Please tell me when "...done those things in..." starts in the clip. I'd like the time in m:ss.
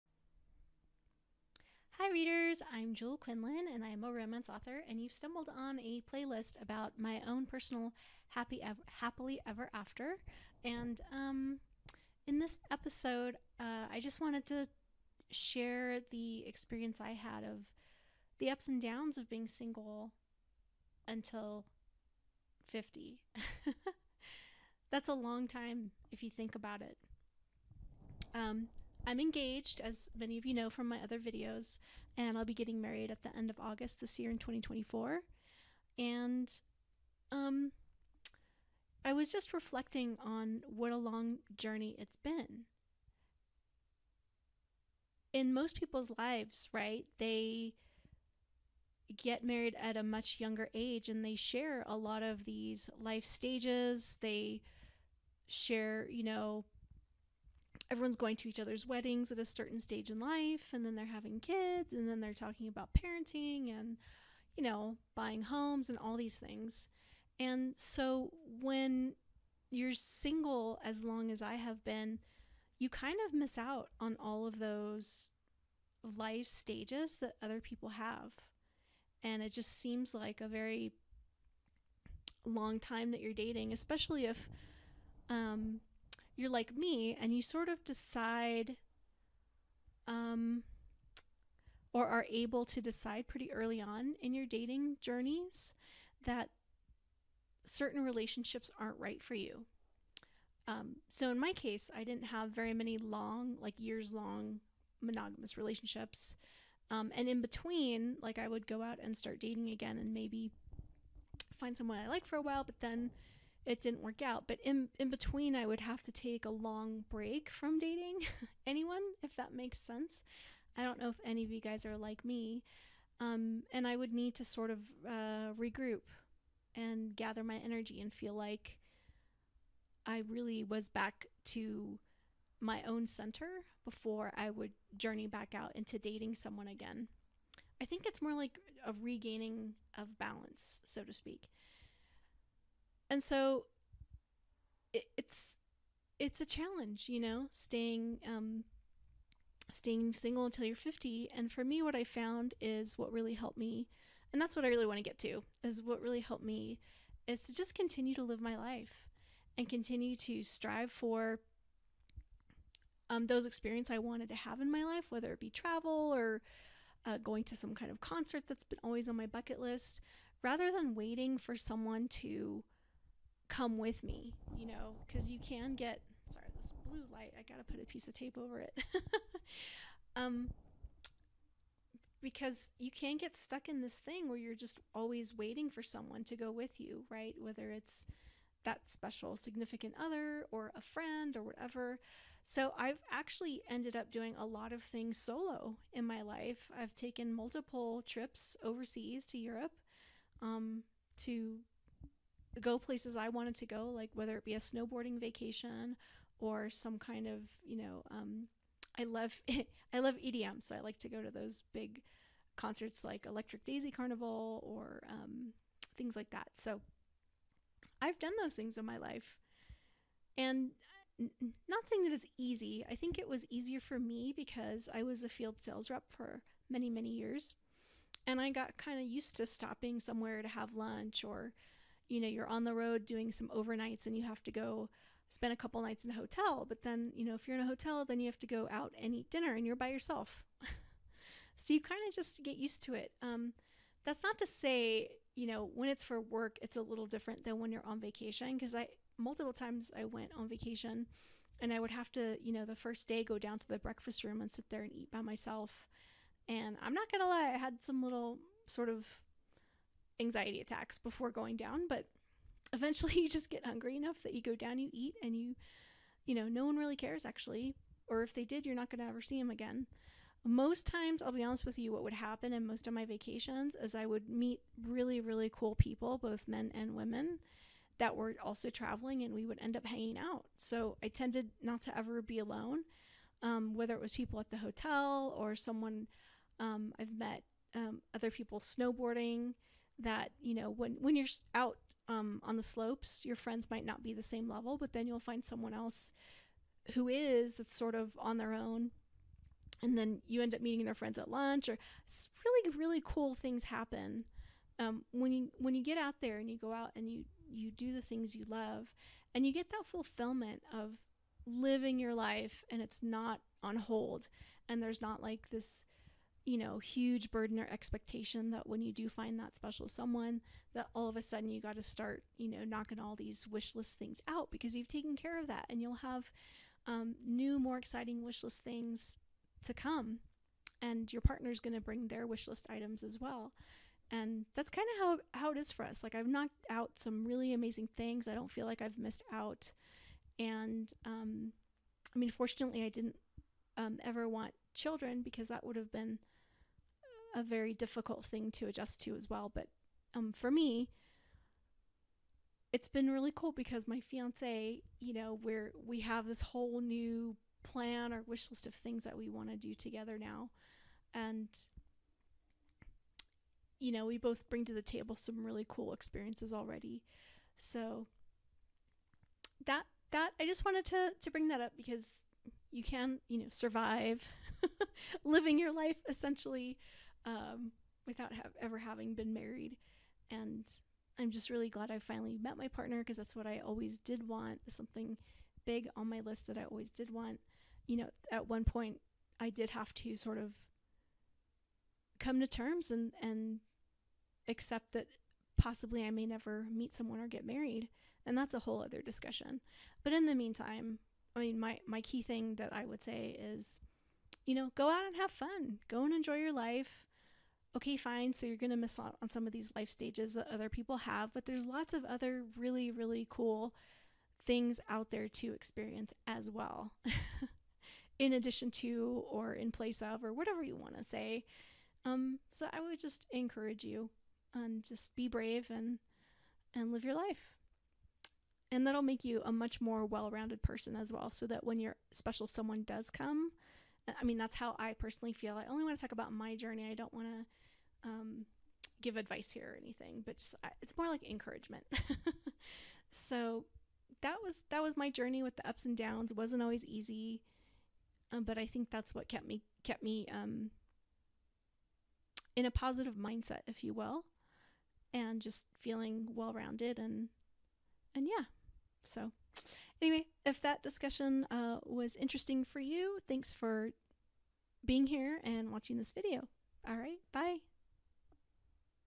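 3:38.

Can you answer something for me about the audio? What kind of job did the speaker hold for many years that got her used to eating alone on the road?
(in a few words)
Field sales rep.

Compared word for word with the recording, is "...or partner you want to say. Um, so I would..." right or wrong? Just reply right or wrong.
wrong.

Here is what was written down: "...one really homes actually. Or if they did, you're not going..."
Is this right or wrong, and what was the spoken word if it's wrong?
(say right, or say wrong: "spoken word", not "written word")
wrong: "cares", not "homes".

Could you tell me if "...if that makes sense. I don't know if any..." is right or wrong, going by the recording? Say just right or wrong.
right.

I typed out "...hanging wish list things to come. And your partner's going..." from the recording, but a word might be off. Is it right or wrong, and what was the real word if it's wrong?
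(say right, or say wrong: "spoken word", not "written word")
wrong: "exciting", not "hanging".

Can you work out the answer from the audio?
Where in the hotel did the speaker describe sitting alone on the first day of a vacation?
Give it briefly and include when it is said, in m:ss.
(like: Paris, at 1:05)
The breakfast room, at 4:13.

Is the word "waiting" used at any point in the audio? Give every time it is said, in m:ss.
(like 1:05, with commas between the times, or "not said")
2:50, 3:05.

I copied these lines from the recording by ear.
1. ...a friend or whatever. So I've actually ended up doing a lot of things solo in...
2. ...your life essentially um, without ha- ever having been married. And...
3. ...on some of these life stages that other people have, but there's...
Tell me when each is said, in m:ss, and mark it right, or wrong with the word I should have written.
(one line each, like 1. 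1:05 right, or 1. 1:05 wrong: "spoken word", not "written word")
1. 3:10 right
2. 6:15 right
3. 6:49 right.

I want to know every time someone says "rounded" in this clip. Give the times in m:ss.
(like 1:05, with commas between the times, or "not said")
7:10, 7:36.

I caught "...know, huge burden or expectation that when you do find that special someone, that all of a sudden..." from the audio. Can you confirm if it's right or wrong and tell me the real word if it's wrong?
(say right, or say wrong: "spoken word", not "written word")
right.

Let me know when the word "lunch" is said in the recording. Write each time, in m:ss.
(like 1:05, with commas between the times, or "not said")
3:50, 5:01.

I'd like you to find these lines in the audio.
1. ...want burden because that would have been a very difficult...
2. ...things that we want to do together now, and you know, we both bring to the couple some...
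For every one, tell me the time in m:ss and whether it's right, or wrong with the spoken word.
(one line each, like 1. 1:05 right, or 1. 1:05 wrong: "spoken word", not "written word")
1. 5:44 wrong: "children", not "burden"
2. 5:58 wrong: "table", not "couple".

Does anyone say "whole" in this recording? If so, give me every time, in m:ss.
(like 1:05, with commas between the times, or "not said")
5:56, 6:38.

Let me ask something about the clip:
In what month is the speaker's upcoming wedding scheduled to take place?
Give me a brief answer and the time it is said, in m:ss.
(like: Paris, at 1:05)
August, at 0:33.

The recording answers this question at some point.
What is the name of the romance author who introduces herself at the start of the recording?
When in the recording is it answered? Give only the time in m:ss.
0:02.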